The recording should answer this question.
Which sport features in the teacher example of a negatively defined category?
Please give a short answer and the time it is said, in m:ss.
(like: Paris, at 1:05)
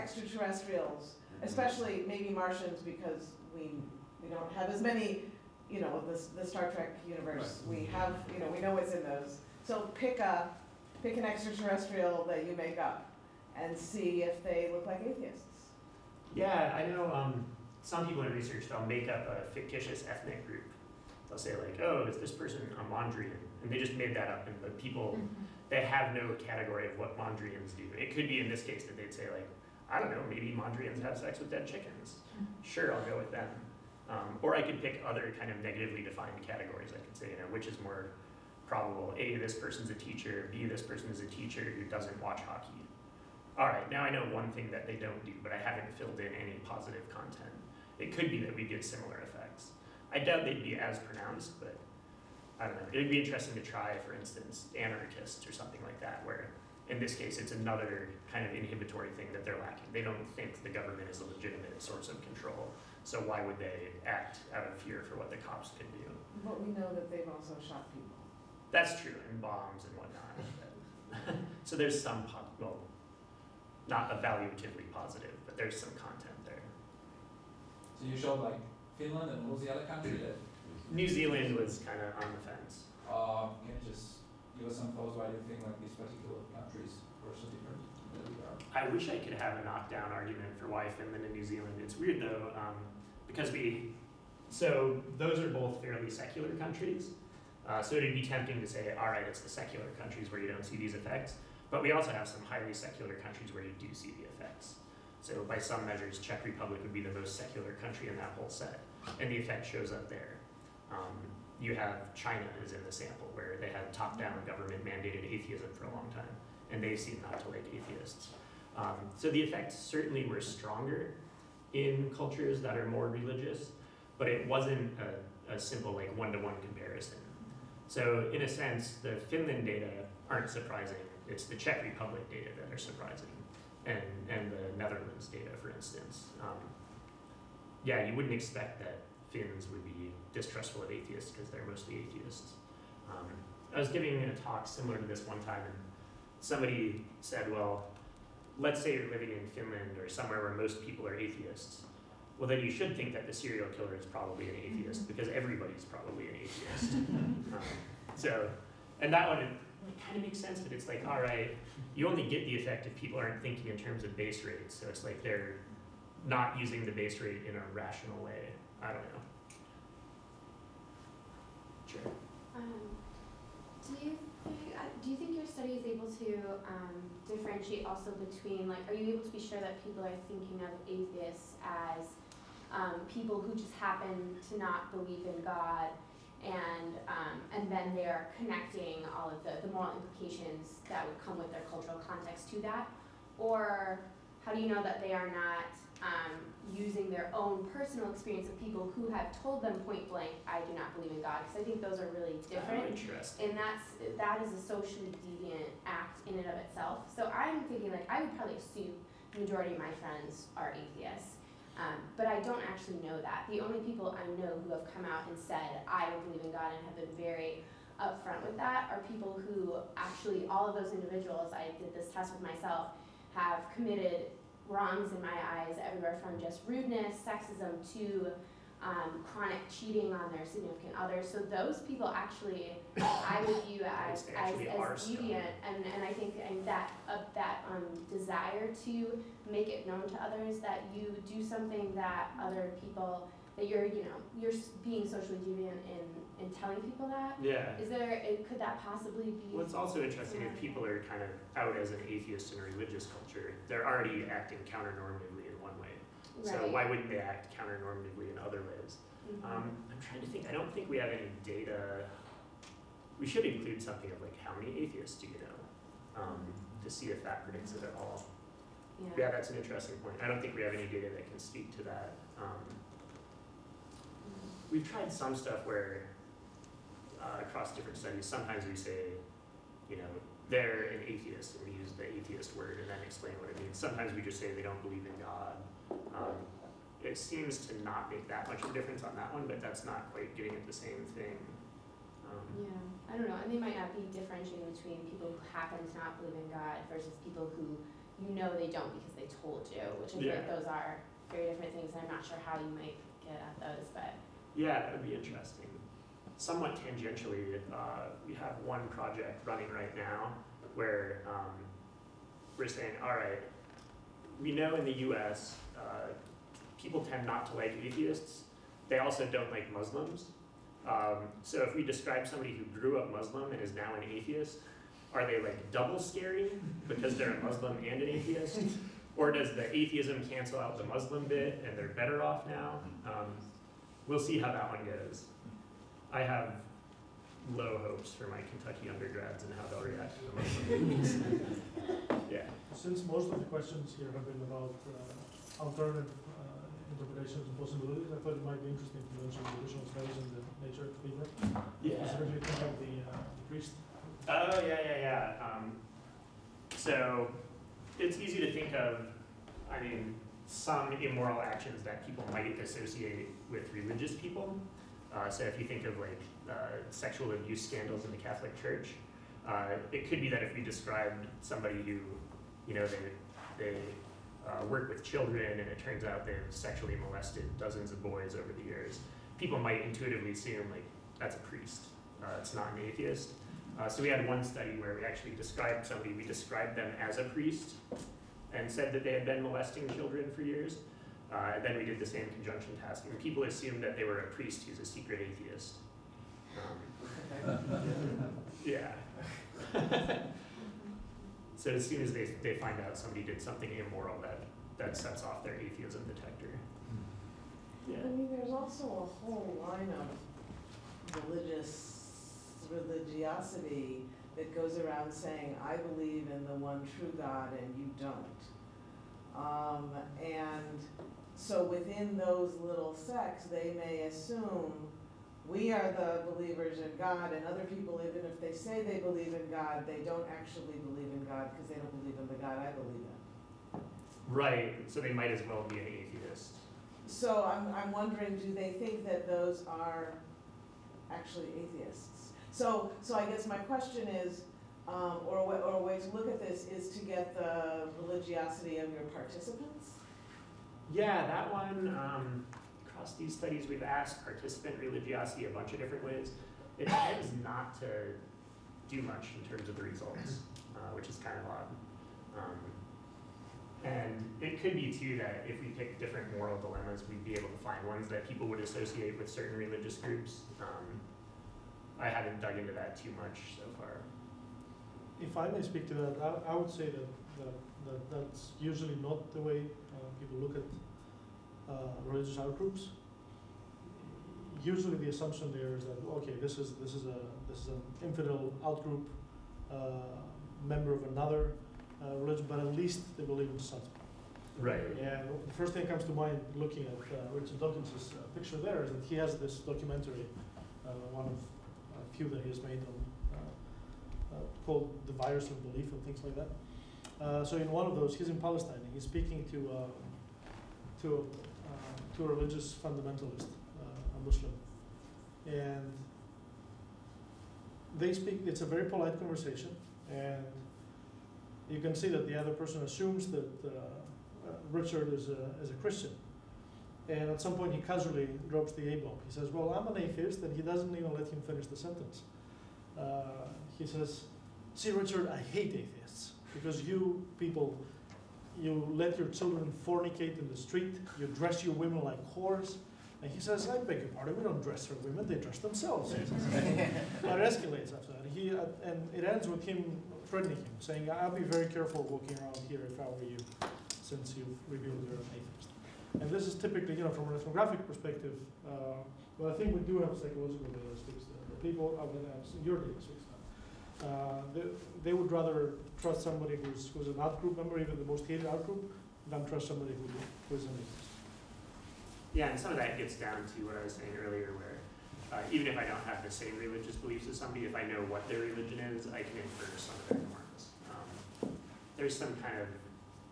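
Hockey, at 0:42.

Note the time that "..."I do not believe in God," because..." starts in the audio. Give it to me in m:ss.
3:20.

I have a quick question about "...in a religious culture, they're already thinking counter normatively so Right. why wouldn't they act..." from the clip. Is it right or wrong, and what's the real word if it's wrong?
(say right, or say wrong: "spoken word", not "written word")
wrong: "acting", not "thinking".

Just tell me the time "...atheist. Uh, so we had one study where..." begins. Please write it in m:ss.
6:22.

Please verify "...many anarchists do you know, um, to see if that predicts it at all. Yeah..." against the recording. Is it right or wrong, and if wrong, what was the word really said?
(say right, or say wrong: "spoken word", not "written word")
wrong: "atheists", not "anarchists".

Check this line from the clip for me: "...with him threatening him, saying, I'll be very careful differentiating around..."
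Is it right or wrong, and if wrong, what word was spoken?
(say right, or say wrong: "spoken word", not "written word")
wrong: "walking", not "differentiating".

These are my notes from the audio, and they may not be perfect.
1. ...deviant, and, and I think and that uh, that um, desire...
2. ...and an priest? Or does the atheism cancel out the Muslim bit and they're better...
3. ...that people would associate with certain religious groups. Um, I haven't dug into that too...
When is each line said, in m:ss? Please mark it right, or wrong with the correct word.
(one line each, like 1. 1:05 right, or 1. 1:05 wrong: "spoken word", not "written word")
1. 3:54 right
2. 5:27 wrong: "atheist", not "priest"
3. 7:48 right.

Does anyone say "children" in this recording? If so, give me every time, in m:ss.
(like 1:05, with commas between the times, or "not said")
6:15, 6:29, 8:59.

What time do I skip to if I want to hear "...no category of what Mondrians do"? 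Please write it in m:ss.
0:26.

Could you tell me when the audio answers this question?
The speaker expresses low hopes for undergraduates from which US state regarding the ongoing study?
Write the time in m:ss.
5:38.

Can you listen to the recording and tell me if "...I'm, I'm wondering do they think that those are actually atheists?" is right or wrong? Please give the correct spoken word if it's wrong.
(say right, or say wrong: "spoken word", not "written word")
right.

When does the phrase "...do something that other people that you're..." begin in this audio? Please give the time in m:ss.
4:01.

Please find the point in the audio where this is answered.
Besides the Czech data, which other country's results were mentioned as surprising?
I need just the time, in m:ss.
2:14.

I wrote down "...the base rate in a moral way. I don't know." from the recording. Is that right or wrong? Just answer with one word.
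wrong.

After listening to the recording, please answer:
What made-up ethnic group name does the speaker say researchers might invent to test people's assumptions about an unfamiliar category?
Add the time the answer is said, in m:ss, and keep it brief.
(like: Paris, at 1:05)
Mondrian, at 0:22.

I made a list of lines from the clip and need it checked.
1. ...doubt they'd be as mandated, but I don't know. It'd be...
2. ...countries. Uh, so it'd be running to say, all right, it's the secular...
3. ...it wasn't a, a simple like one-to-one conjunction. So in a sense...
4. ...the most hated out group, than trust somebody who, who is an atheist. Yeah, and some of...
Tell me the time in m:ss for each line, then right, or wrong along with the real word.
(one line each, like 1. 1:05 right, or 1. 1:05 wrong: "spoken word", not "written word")
1. 0:50 wrong: "pronounced", not "mandated"
2. 1:36 wrong: "tempting", not "running"
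3. 2:04 wrong: "comparison", not "conjunction"
4. 9:27 right.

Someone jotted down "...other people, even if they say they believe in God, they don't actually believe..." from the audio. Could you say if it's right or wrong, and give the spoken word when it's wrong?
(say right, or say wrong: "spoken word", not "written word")
right.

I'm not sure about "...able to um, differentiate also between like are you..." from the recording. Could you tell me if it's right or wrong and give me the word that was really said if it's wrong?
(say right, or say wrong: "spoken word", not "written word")
right.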